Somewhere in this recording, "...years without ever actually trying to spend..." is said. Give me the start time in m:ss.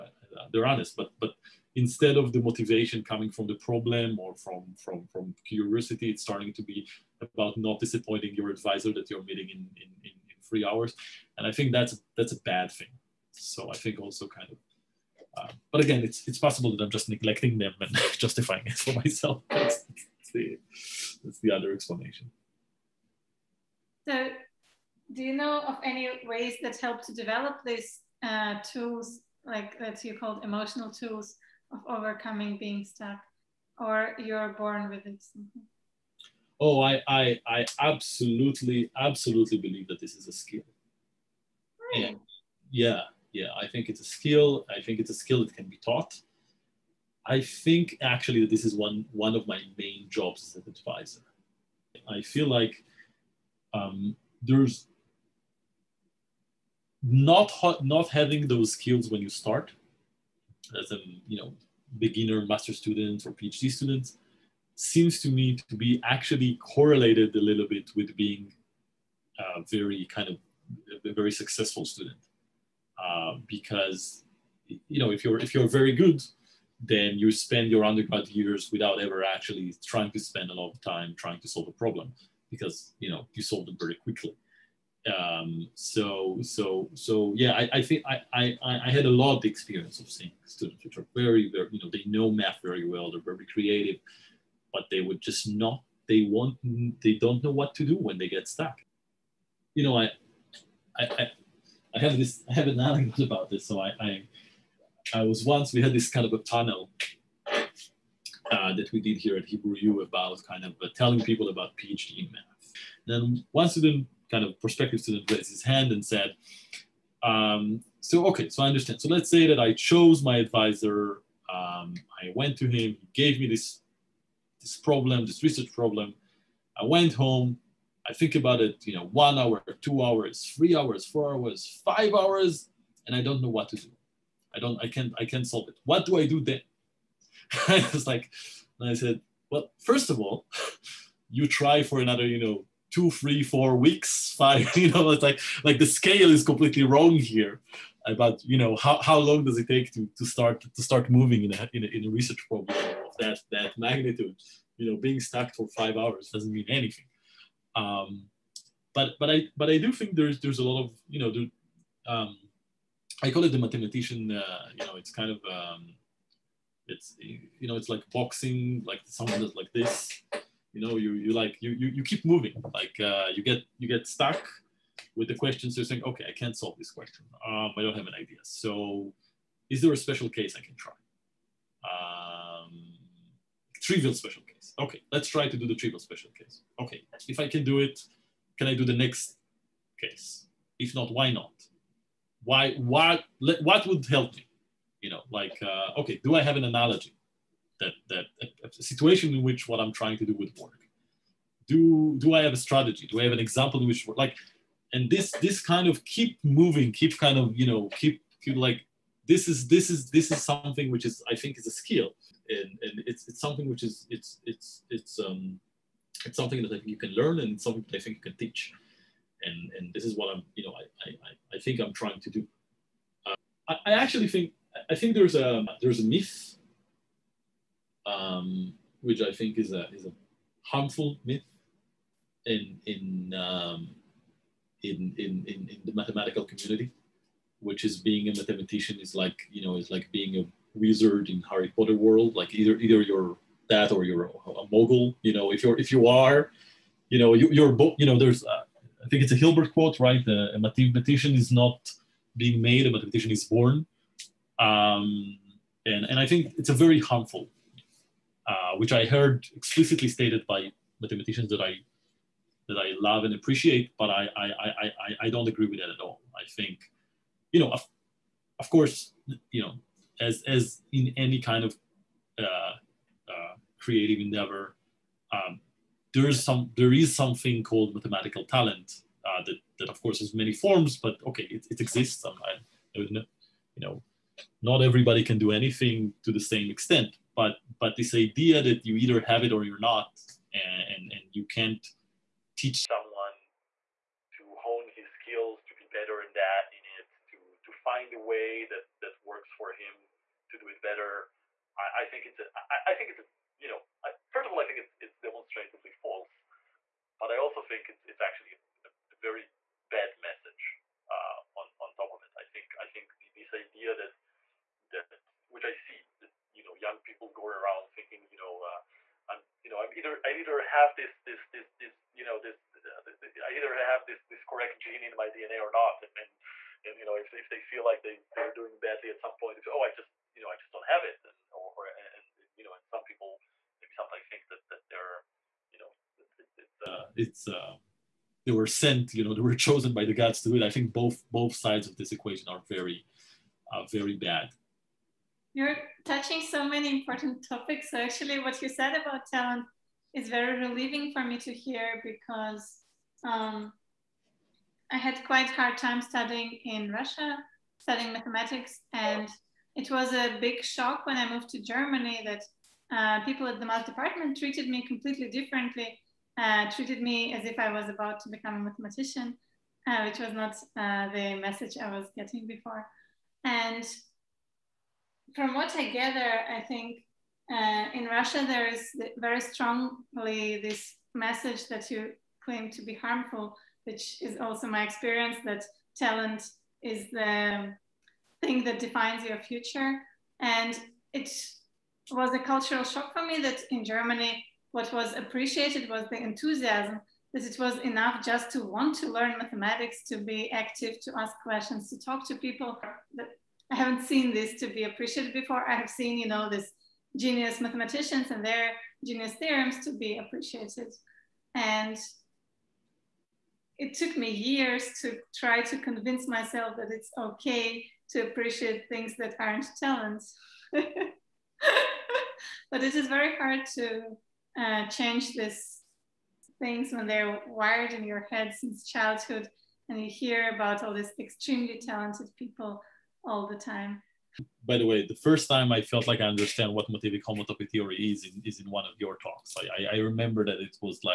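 1:18.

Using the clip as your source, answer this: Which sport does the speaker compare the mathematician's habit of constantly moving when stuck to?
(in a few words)
boxing.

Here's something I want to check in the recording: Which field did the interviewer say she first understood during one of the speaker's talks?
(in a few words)
motivic homotopy theory.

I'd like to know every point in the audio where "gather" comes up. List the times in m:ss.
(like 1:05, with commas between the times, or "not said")
6:15.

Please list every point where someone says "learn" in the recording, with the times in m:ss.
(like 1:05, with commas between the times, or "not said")
3:37, 6:39.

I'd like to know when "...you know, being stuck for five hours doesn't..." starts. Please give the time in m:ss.
2:34.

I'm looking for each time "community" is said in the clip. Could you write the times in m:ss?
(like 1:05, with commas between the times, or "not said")
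3:56.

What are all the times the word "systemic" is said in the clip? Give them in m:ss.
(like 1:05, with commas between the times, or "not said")
not said.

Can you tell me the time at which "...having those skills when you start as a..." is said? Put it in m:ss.
0:58.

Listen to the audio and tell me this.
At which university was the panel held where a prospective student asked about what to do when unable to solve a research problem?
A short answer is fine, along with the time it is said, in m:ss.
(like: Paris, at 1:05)
Hebrew U, at 1:49.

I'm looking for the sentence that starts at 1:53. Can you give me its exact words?
Then one student, kind of prospective student, raised his hand and said, um, "So okay, so I understand.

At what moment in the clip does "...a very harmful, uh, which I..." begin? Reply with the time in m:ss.
4:16.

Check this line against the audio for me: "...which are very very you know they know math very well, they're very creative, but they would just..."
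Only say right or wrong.
right.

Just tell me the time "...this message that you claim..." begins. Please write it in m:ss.
6:20.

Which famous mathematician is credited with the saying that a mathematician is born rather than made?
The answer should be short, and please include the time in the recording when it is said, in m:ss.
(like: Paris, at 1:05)
Hilbert, at 4:09.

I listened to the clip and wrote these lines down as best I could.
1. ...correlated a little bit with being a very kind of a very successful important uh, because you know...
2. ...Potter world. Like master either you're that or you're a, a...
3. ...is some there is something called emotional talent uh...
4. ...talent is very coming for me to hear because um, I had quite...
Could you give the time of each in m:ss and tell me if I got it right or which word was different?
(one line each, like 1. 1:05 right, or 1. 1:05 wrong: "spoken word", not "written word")
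1. 1:06 wrong: "student", not "important"
2. 4:01 wrong: "either", not "master"
3. 4:36 wrong: "mathematical", not "emotional"
4. 5:49 wrong: "relieving", not "coming".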